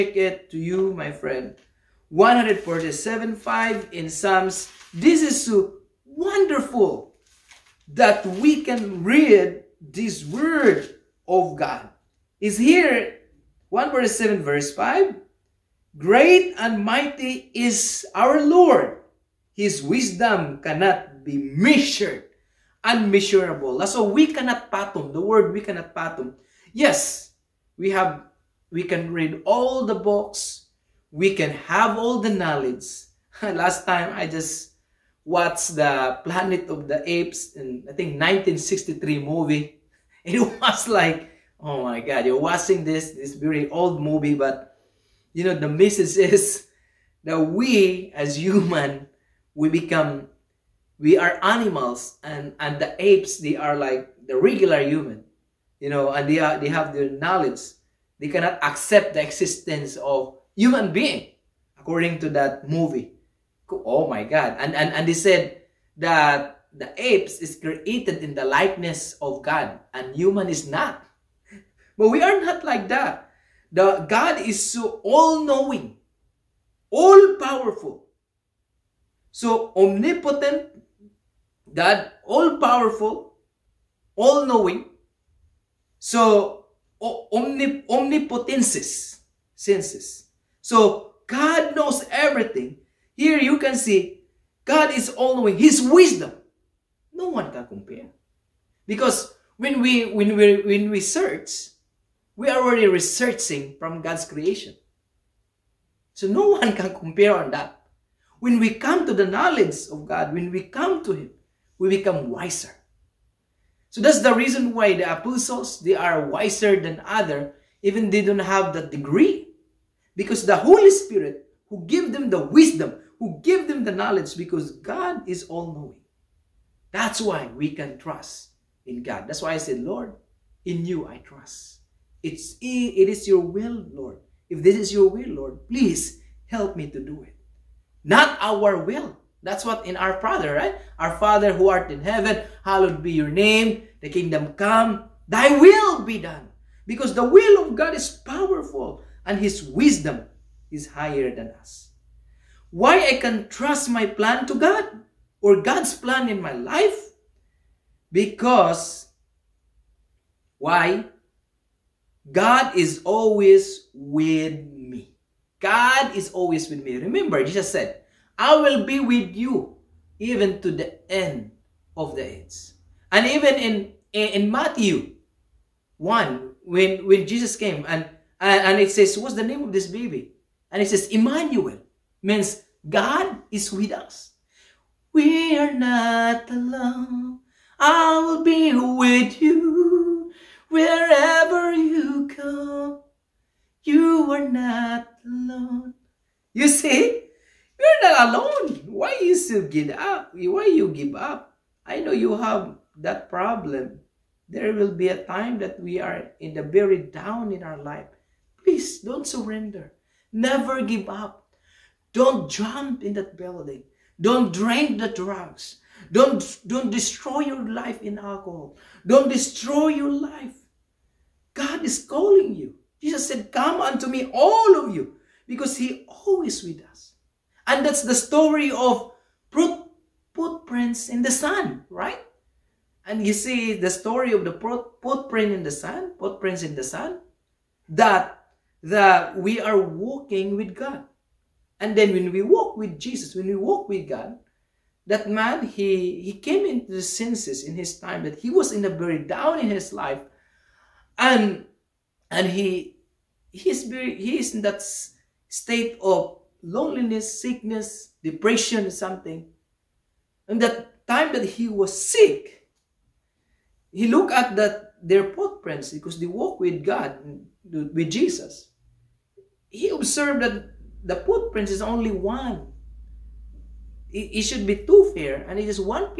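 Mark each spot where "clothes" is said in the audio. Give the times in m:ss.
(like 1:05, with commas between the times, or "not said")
not said.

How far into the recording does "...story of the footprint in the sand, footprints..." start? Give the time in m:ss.
3:53.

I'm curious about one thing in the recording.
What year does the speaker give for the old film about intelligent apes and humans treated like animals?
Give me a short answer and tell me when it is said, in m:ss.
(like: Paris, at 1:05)
1963, at 0:38.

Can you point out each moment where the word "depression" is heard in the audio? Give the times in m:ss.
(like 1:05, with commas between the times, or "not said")
4:18.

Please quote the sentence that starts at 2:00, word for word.
Because the Holy Spirit who give them the wisdom, who give them the knowledge, because God is all-knowing.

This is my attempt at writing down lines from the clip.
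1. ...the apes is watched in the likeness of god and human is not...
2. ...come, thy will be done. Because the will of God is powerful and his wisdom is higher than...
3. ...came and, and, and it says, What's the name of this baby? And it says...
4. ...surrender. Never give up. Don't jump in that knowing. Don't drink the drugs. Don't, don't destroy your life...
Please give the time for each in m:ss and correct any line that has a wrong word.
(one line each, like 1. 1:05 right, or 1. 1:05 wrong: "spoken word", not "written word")
1. 1:06 wrong: "created", not "watched"
2. 2:24 right
3. 2:57 right
4. 3:29 wrong: "building", not "knowing".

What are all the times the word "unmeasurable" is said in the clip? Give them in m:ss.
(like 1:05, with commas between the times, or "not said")
0:22.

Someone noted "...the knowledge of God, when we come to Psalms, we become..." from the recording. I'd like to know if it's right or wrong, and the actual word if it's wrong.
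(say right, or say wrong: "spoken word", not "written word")
wrong: "Him", not "Psalms".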